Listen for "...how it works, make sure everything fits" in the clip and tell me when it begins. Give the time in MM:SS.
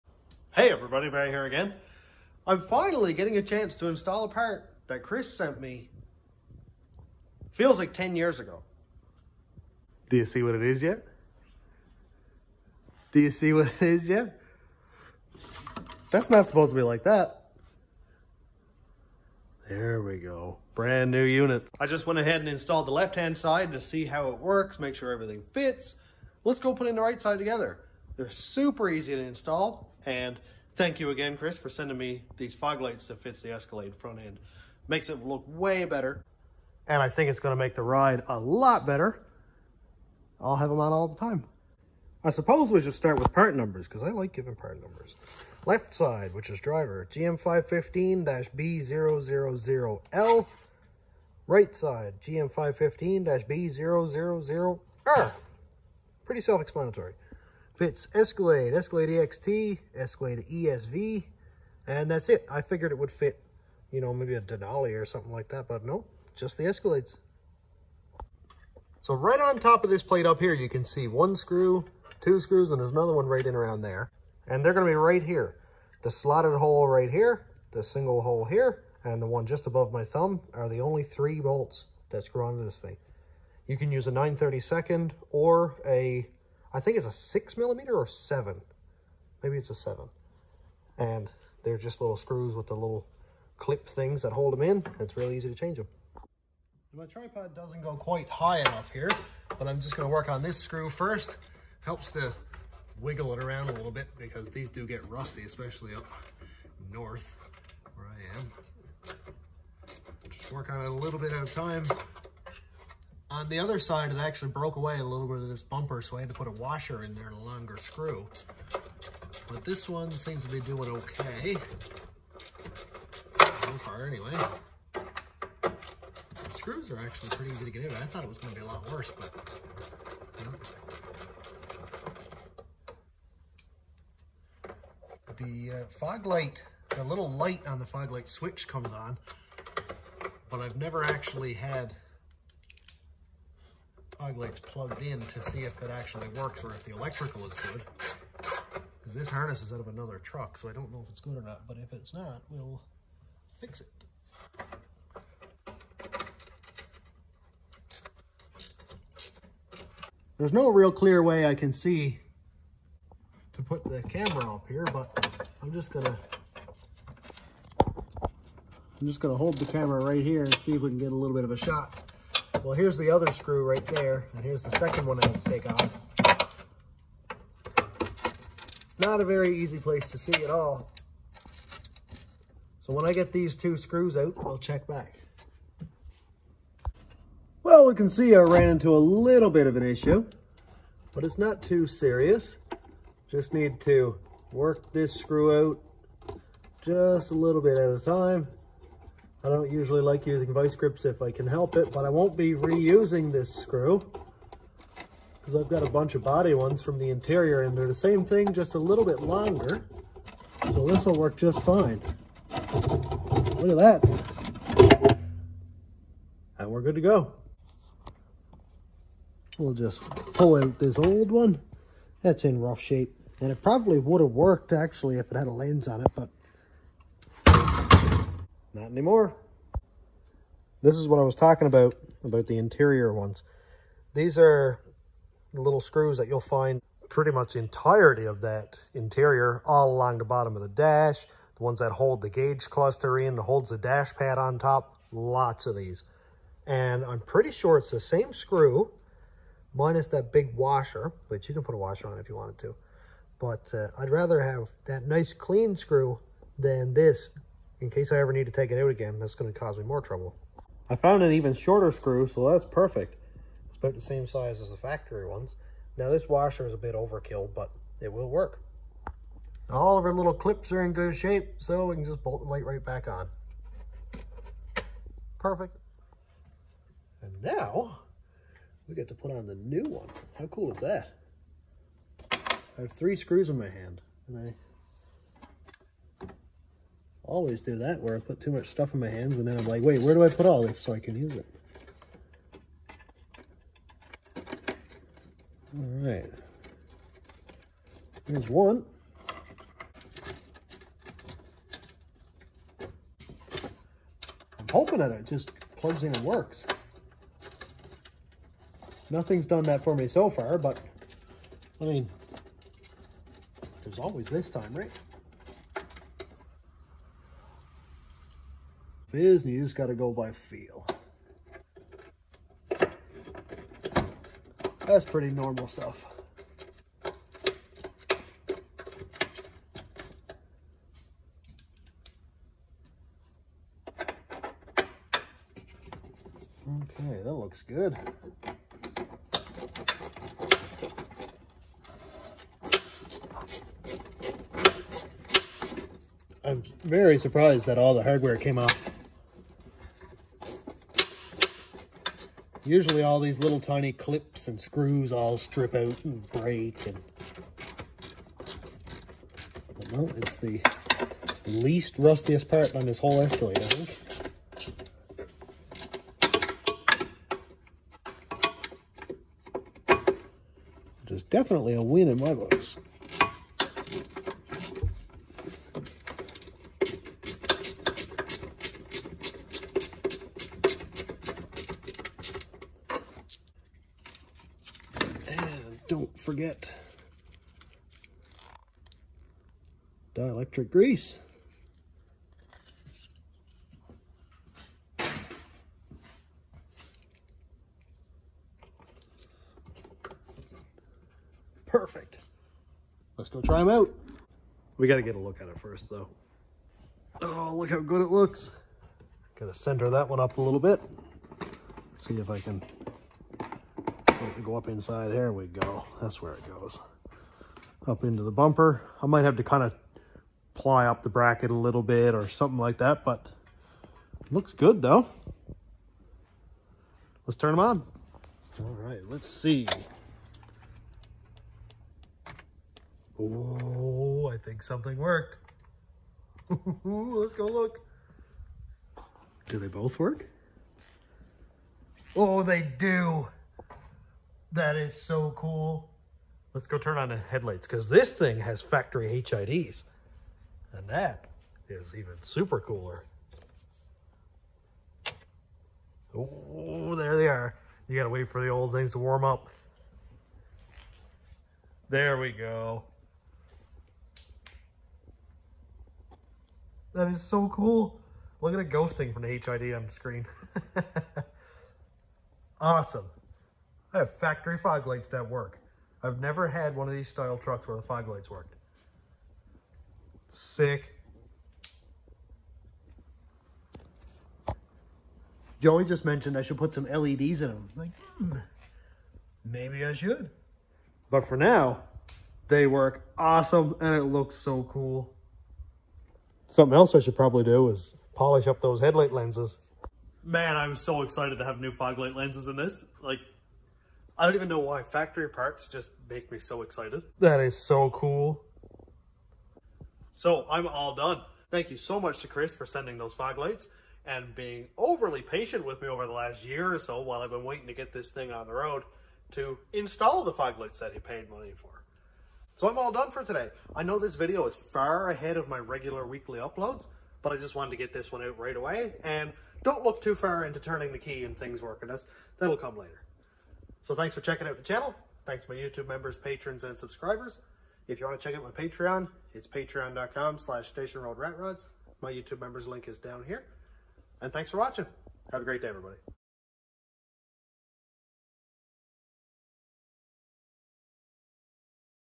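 00:24.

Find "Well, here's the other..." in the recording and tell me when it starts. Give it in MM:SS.
02:52.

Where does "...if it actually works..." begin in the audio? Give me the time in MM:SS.
02:25.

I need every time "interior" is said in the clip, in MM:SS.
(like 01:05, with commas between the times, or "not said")
03:27, 03:52, 03:58.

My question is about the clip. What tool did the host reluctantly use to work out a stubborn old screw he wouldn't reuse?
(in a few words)
Vice grips.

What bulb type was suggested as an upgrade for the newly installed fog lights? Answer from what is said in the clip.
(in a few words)
LEDs.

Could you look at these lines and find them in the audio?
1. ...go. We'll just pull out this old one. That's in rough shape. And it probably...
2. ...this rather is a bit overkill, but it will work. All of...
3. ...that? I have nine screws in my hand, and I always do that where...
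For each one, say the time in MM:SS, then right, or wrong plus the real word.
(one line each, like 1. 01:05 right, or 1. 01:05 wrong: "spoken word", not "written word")
1. 03:37 right
2. 04:26 wrong: "washer", not "rather"
3. 04:40 wrong: "three", not "nine".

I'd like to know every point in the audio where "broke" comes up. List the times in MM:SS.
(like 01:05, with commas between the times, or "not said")
01:54.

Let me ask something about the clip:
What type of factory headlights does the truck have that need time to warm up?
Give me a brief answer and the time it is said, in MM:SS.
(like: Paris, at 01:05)
HIDs, at 07:29.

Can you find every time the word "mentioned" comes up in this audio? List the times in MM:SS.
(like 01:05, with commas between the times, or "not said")
08:06.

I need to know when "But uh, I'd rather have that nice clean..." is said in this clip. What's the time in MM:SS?
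04:13.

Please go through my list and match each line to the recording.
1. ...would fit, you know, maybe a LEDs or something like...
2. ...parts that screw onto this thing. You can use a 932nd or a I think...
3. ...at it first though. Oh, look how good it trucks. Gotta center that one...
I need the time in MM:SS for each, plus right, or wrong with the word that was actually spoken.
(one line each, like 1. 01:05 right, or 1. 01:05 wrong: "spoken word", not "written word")
1. 01:02 wrong: "Denali", not "LEDs"
2. 01:21 wrong: "bolts", not "parts"
3. 06:45 wrong: "looks", not "trucks".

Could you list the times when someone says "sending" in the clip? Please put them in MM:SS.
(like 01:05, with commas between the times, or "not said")
00:31, 08:32.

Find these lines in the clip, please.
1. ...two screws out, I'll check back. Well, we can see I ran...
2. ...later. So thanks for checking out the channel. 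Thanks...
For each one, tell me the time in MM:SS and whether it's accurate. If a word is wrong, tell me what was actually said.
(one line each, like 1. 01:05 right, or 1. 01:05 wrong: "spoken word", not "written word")
1. 03:03 right
2. 08:52 right.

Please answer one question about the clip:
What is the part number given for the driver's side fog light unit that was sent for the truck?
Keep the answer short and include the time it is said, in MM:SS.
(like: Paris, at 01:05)
GM515-B000L, at 00:47.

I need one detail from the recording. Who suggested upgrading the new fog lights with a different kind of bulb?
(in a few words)
Joey.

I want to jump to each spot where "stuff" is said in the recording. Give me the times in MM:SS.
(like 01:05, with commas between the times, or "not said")
04:48, 05:25.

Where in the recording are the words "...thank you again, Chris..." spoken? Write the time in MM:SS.
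00:30.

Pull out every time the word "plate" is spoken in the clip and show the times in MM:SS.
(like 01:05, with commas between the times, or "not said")
01:10.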